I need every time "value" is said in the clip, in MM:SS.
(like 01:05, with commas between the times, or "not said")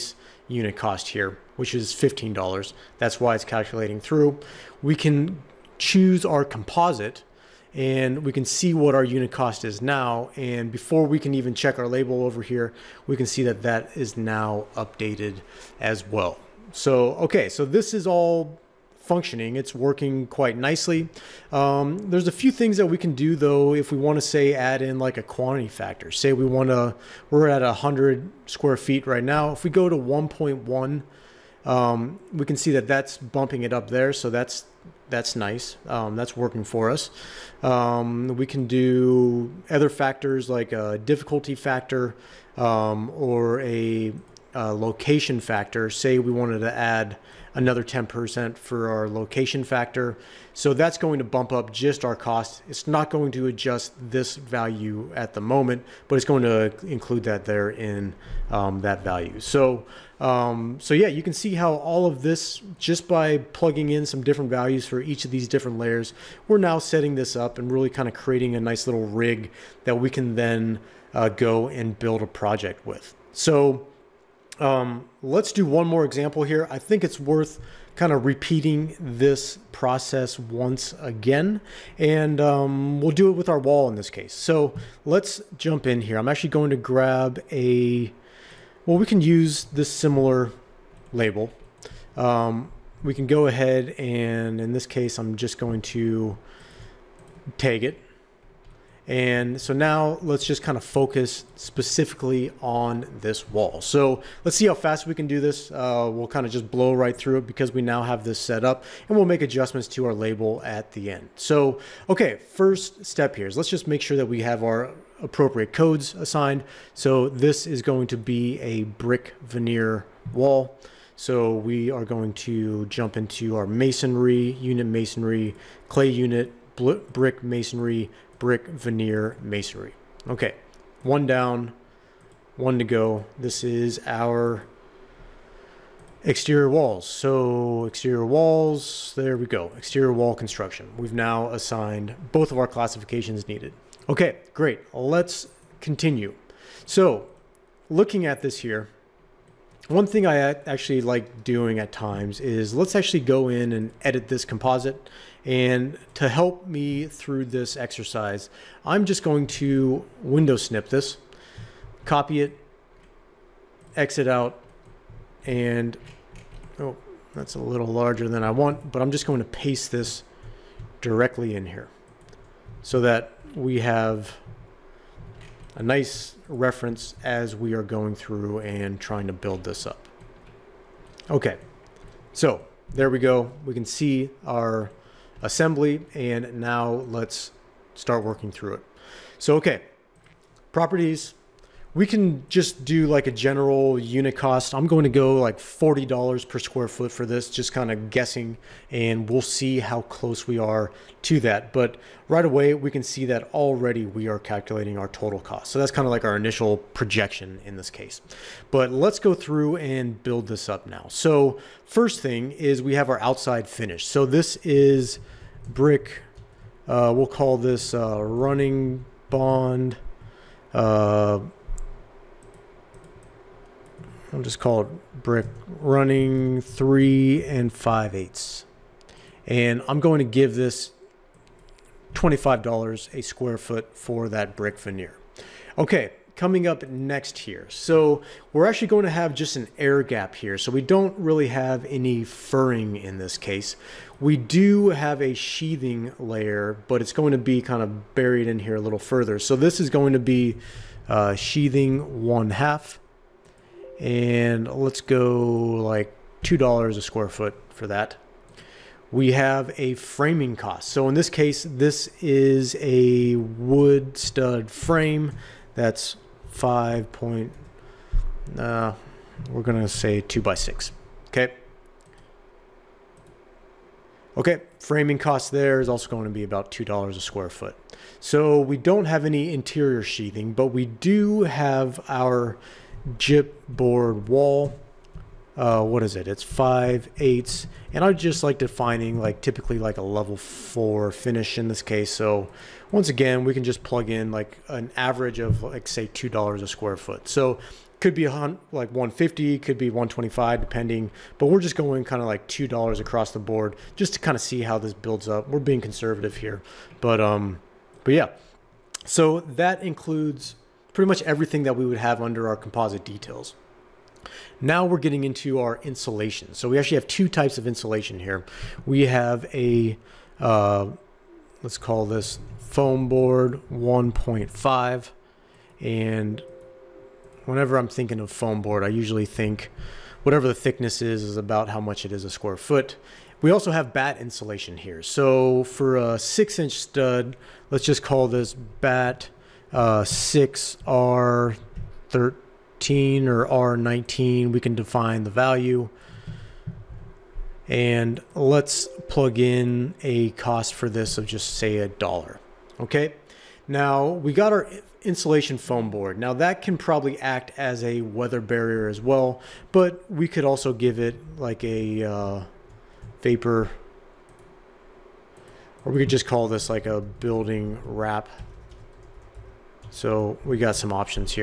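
00:54, 00:59, 01:04, 05:45.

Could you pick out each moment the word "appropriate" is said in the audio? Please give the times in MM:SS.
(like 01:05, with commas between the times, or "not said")
01:55.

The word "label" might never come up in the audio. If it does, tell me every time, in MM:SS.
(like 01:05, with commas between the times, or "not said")
00:11, 01:31, 01:50.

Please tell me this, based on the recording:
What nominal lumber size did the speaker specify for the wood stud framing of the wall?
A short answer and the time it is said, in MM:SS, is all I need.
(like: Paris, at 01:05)
2 by 6, at 04:30.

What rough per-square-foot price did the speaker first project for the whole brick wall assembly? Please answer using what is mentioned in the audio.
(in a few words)
$40.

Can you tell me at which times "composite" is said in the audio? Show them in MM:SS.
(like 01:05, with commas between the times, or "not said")
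00:06, 02:34, 05:12.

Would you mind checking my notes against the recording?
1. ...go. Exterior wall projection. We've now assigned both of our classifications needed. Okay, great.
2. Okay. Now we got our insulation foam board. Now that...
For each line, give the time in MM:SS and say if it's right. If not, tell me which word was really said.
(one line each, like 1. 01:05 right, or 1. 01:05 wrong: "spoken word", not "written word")
1. 02:19 wrong: "construction", not "projection"
2. 05:52 right.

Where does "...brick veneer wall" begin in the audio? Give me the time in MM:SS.
01:58.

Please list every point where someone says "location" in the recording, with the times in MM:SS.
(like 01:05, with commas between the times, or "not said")
00:44, 00:49.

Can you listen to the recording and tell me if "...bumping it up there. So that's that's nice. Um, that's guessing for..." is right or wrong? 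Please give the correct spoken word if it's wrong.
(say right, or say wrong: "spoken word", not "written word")
wrong: "working", not "guessing".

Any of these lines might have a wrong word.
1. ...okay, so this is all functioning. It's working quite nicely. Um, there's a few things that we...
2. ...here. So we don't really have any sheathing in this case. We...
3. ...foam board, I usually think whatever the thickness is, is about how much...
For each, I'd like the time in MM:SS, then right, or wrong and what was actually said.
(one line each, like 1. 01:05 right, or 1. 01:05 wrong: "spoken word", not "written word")
1. 00:17 right
2. 04:00 wrong: "furring", not "sheathing"
3. 05:28 right.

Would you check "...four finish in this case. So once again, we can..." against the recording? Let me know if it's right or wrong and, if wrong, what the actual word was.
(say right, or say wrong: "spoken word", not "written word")
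right.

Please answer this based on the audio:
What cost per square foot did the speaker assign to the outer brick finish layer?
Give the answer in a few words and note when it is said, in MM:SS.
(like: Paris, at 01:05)
$25, at 03:52.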